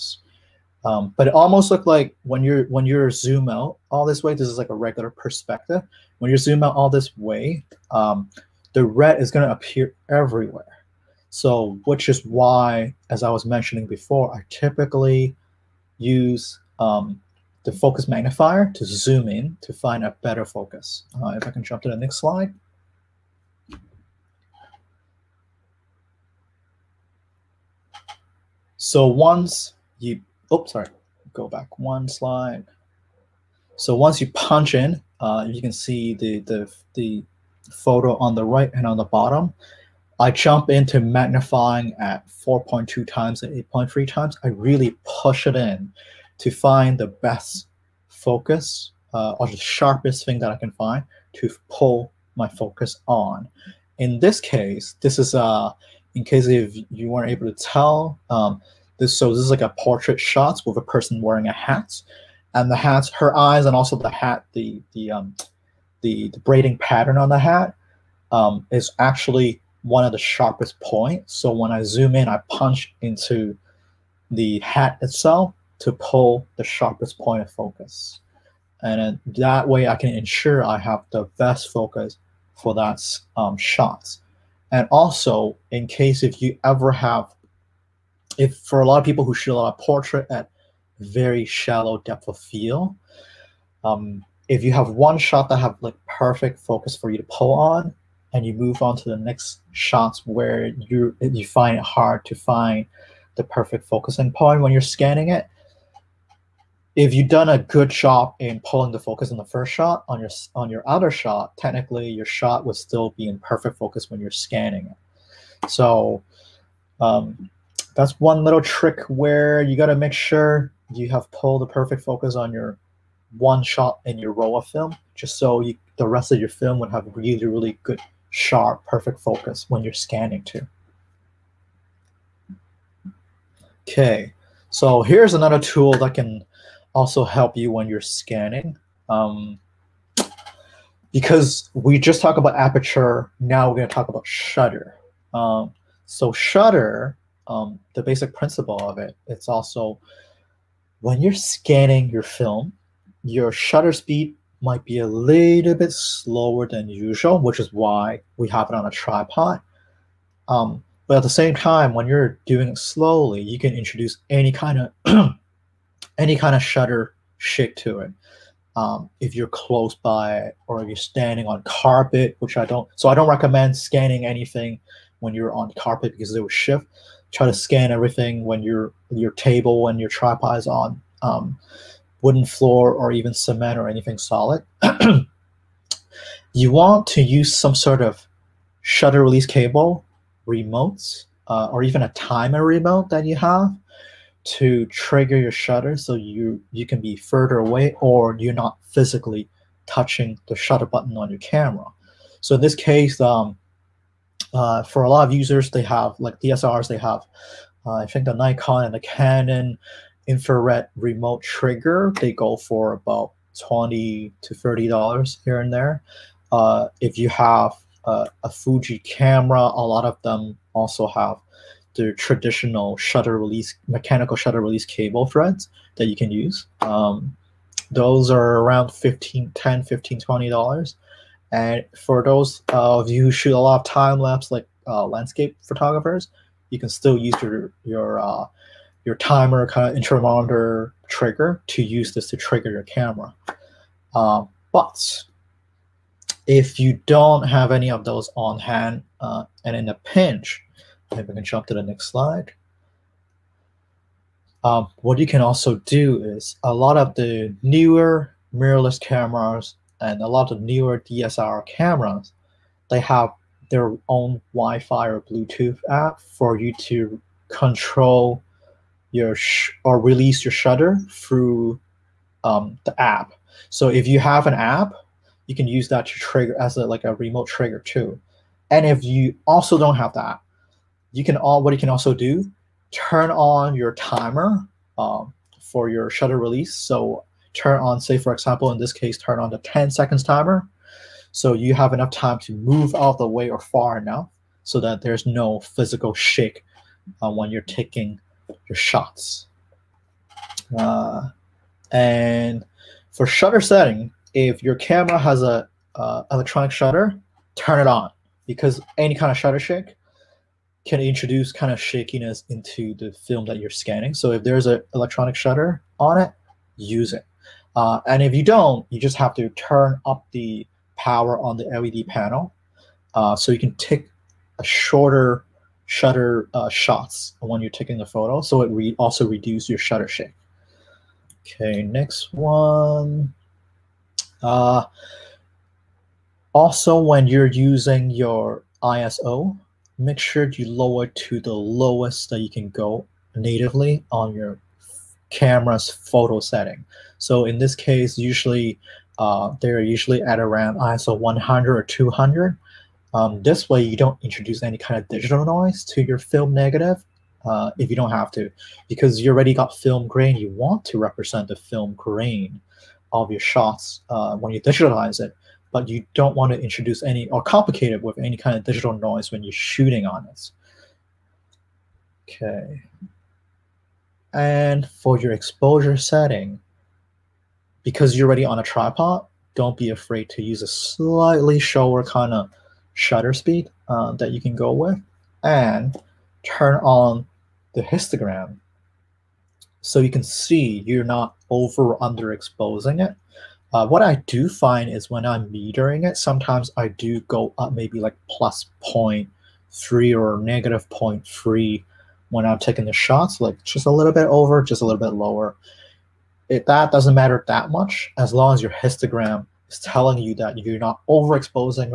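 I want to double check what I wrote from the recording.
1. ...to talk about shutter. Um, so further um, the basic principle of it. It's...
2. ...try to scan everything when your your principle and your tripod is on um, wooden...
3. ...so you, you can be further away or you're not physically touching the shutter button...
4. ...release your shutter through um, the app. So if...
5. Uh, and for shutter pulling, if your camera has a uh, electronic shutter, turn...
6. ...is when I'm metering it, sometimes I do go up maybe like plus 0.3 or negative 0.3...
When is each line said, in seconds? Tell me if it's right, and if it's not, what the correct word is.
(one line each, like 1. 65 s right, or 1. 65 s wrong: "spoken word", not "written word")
1. 143 s wrong: "shutter", not "further"
2. 177 s wrong: "table", not "principle"
3. 195 s right
4. 269 s right
5. 300 s wrong: "setting", not "pulling"
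6. 394 s right.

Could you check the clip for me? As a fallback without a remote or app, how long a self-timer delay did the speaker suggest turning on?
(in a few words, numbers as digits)
10 seconds.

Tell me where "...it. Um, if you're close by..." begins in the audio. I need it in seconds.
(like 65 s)
168 s.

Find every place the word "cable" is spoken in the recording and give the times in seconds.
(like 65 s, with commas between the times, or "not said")
189 s, 224 s.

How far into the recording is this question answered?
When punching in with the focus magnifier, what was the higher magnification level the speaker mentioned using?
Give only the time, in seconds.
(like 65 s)
43 s.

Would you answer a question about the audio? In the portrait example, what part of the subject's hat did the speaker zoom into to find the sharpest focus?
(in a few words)
braiding pattern.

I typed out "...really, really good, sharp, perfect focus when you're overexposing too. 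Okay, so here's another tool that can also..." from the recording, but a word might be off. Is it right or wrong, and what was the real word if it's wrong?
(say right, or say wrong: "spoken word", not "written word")
wrong: "scanning", not "overexposing".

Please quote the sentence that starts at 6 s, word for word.
When you zoom out all this way, um, the red is going to appear everywhere.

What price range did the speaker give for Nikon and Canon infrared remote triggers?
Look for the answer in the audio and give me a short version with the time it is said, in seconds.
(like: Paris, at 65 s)
$20 to $30, at 213 s.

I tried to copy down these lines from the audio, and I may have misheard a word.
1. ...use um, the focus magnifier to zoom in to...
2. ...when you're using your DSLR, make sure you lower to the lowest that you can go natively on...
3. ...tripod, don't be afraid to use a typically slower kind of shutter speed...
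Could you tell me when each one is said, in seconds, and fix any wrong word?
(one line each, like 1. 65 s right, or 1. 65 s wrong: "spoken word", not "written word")
1. 15 s right
2. 336 s wrong: "ISO", not "DSLR"
3. 378 s wrong: "slightly", not "typically".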